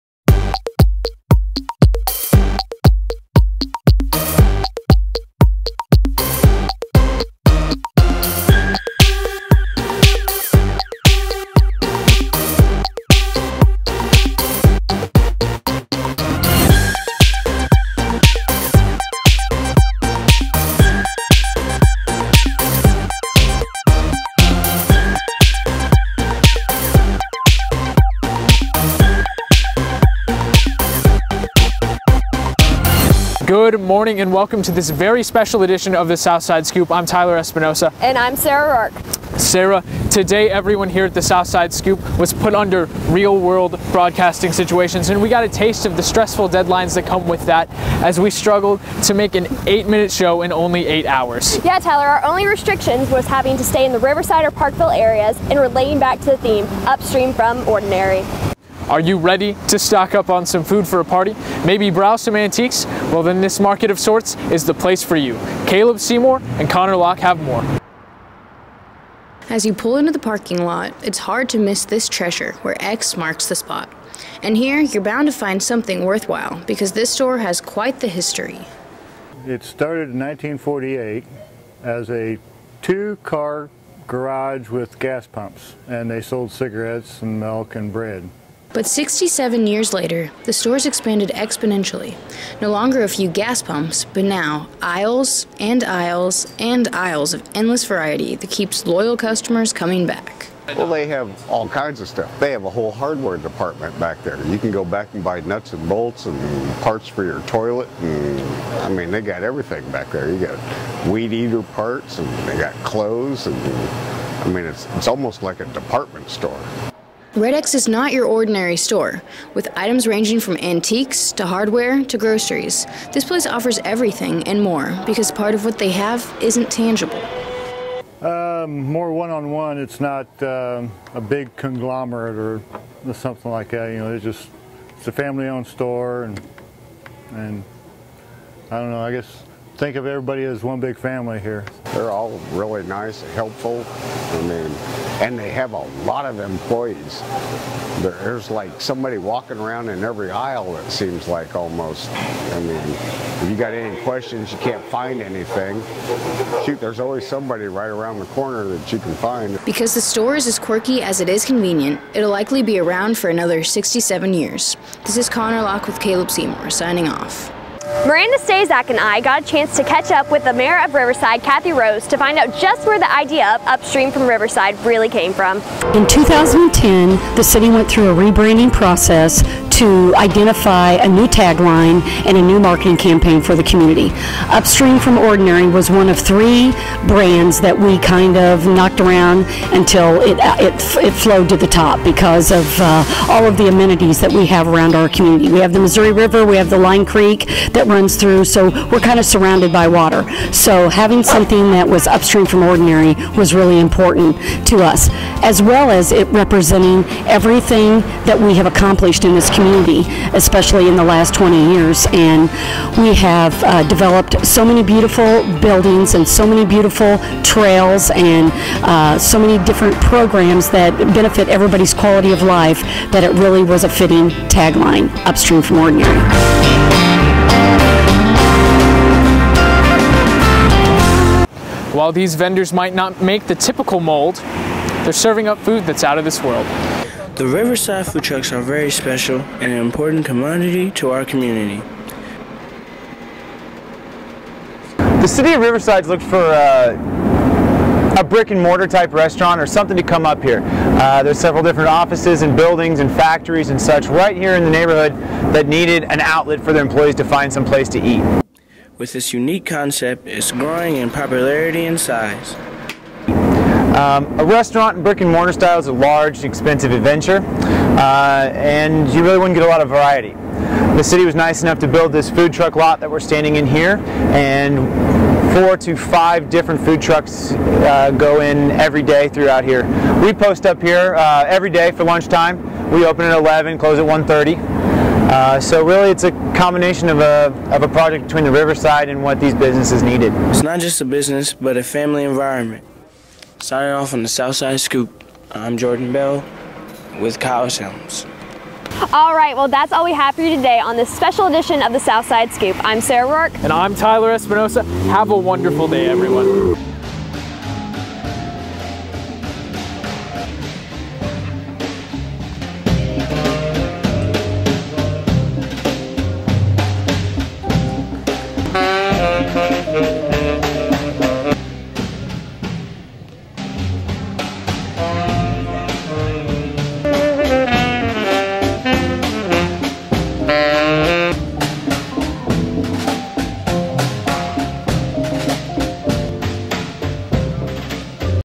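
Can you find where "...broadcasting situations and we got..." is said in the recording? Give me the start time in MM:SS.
00:43.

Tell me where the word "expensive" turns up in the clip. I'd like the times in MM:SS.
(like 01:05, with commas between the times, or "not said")
04:26.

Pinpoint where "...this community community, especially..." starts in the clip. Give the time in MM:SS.
03:29.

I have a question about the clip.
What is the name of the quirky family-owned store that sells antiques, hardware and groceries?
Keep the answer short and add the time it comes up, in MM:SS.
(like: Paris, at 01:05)
Red X, at 01:57.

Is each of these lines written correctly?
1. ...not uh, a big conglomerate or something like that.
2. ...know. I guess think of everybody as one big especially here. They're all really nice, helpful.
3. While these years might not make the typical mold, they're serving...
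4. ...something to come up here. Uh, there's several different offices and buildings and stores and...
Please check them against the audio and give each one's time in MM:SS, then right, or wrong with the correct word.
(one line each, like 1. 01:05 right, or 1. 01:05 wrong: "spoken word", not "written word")
1. 02:10 right
2. 02:18 wrong: "family", not "especially"
3. 03:51 wrong: "vendors", not "years"
4. 04:09 wrong: "factories", not "stores".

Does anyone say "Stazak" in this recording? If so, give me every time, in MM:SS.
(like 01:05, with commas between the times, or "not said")
02:48.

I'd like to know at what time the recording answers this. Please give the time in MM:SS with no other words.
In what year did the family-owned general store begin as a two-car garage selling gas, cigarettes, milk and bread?
01:20.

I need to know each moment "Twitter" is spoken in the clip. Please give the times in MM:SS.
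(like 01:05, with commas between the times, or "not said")
not said.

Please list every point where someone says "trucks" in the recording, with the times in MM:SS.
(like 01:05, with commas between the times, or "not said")
03:58, 04:32, 04:37.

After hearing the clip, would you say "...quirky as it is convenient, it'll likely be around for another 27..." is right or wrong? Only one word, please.
wrong.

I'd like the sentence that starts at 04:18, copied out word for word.
With this unique concept, it's growing in popularity and size.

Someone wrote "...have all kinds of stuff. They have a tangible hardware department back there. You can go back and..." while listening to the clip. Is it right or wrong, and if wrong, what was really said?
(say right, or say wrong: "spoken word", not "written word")
wrong: "whole", not "tangible".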